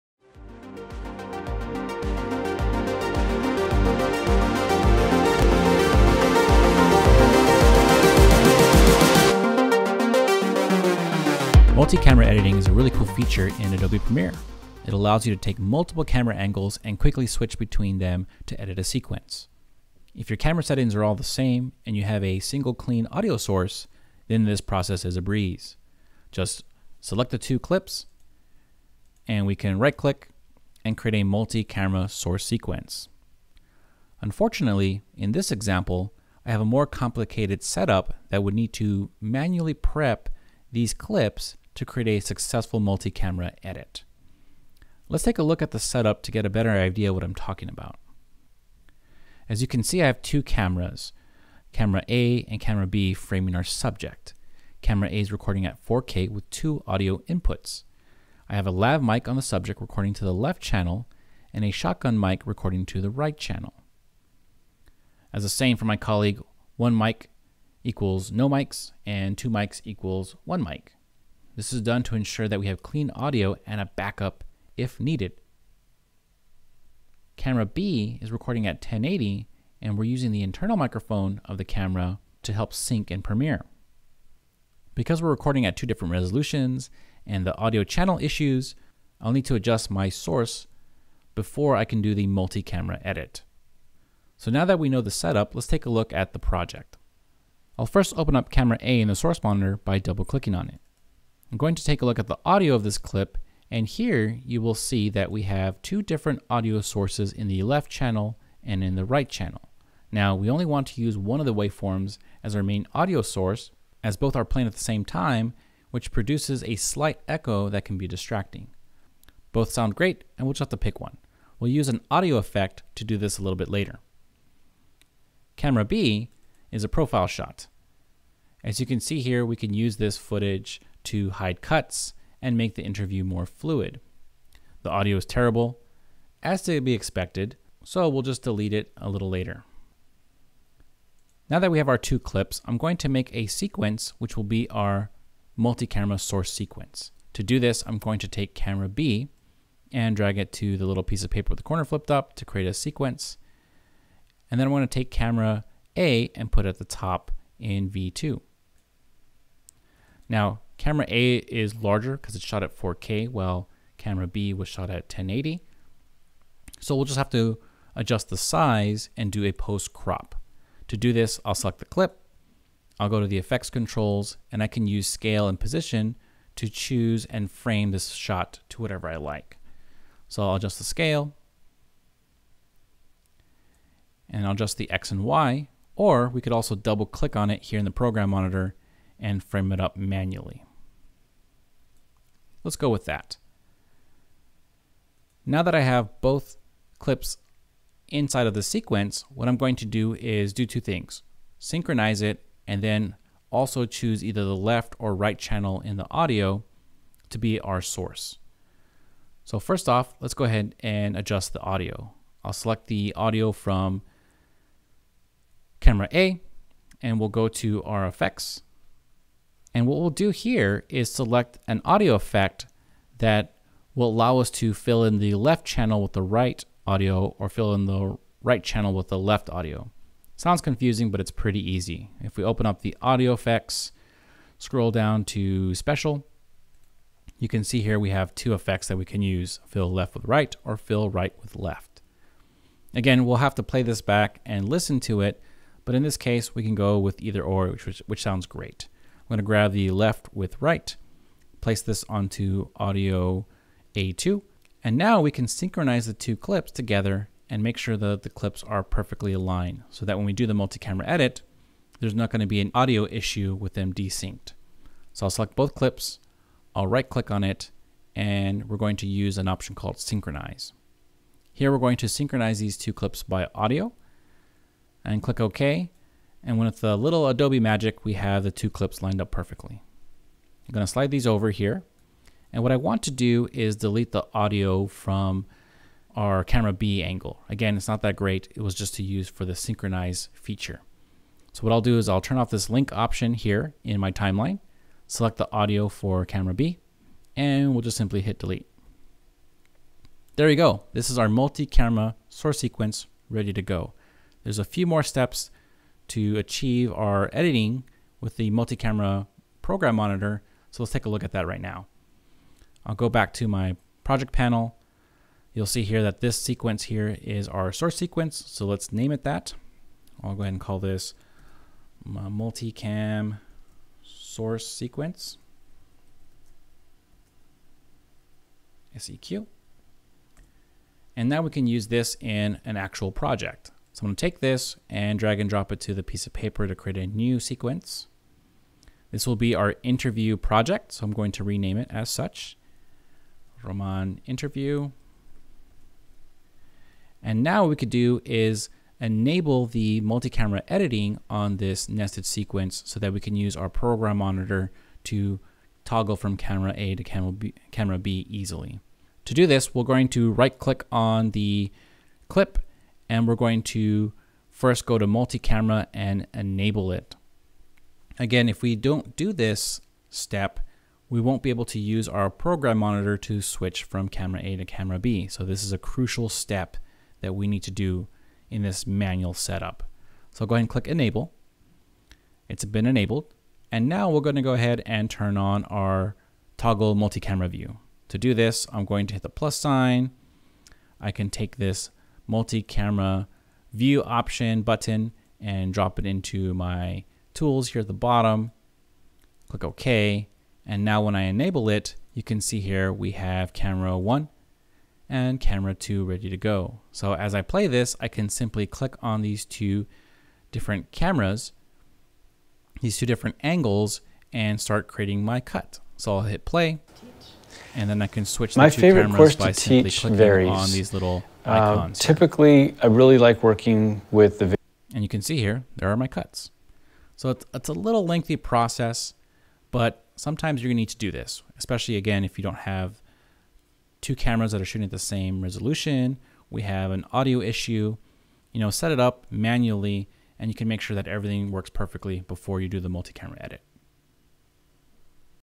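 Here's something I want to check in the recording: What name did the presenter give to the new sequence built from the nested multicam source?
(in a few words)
Roman interview.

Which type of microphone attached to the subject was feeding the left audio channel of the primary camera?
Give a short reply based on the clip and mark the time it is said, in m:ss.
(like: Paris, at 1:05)
lav mic, at 0:58.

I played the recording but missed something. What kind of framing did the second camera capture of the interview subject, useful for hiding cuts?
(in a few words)
profile shot.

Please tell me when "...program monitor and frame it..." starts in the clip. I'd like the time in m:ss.
3:07.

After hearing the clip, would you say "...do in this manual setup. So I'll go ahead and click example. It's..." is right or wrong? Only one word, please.
wrong.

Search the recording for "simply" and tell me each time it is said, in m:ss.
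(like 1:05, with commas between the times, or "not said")
4:57, 6:48.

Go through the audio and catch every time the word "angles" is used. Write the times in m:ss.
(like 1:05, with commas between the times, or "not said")
0:16, 4:47, 6:53.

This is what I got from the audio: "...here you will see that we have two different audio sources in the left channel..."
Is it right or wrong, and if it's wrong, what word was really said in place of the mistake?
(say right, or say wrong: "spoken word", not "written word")
right.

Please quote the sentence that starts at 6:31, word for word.
I can take this multi-camera view option button and drop it into my tools here at the bottom.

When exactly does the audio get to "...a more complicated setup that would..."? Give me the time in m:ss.
0:36.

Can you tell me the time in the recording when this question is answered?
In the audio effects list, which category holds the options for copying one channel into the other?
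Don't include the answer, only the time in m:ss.
3:55.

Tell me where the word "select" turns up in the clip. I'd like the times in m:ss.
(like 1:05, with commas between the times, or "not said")
0:27, 2:51, 3:32, 3:41, 4:25, 4:55.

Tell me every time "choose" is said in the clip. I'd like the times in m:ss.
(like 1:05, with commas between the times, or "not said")
2:56, 3:23.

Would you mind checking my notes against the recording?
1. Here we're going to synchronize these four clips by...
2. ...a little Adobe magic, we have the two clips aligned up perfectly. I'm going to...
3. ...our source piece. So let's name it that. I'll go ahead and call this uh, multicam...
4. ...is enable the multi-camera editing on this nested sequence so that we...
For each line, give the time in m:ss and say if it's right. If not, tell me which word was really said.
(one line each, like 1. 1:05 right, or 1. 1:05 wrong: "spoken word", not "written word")
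1. 4:31 wrong: "two", not "four"
2. 4:36 wrong: "lined", not "aligned"
3. 5:17 wrong: "sequence", not "piece"
4. 5:48 right.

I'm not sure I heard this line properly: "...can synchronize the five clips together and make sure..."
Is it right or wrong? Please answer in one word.
wrong.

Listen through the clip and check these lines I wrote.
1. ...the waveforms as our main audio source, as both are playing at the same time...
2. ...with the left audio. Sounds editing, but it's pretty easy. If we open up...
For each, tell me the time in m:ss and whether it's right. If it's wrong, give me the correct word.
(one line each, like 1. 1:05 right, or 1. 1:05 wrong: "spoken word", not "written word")
1. 1:51 right
2. 3:48 wrong: "confusing", not "editing".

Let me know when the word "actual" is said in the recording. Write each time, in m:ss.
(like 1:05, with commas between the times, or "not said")
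5:32.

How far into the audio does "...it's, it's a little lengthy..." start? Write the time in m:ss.
7:07.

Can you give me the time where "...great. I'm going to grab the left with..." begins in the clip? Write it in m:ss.
4:08.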